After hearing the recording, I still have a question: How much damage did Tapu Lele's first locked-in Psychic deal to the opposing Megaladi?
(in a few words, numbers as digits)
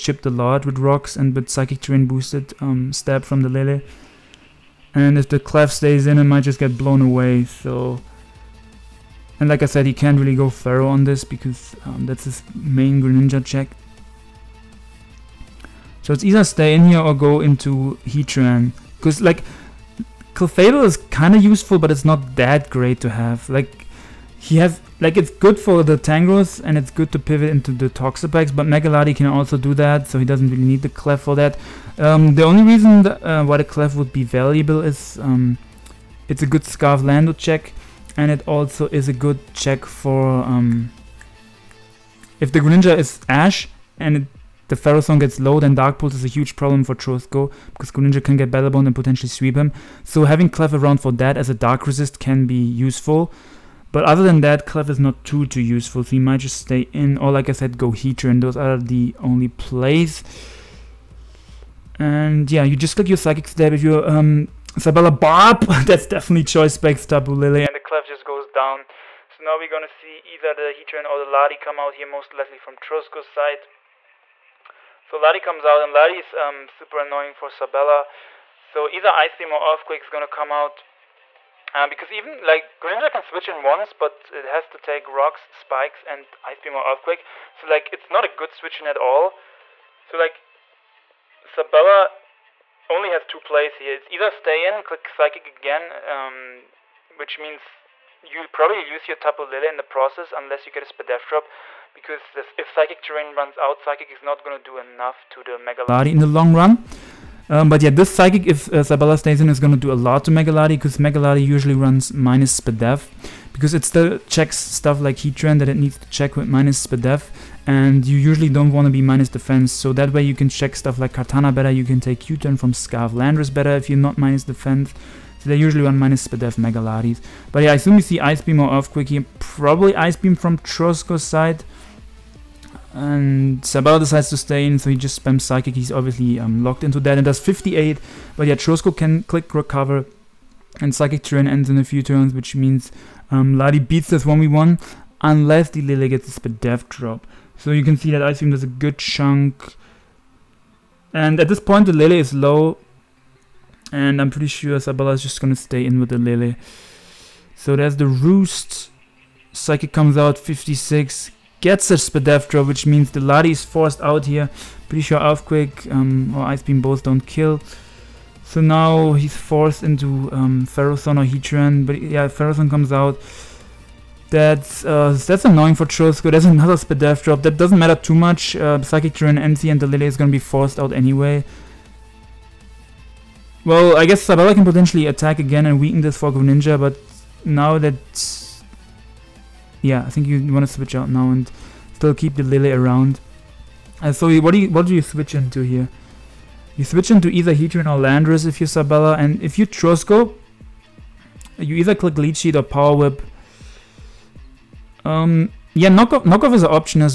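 58.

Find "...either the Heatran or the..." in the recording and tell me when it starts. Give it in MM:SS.
01:10.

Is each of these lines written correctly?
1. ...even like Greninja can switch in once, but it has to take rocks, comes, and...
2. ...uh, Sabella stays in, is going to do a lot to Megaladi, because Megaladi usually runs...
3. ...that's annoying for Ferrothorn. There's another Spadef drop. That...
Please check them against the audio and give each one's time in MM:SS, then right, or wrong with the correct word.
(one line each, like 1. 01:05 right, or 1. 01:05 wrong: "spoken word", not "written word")
1. 01:22 wrong: "spikes", not "comes"
2. 01:48 right
3. 02:55 wrong: "Trosko", not "Ferrothorn".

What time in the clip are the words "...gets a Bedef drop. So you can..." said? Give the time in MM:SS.
02:26.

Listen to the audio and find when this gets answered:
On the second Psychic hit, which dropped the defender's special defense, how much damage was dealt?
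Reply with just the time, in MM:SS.
02:40.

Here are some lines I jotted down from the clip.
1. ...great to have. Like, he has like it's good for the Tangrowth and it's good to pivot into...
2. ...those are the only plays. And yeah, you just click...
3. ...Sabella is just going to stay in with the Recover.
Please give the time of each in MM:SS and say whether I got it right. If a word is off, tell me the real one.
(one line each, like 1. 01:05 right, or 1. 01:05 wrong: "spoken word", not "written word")
1. 00:22 right
2. 00:58 right
3. 02:34 wrong: "Lily", not "Recover".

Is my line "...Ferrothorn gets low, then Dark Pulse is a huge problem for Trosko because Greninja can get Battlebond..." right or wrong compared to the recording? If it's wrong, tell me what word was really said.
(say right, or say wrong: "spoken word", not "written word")
right.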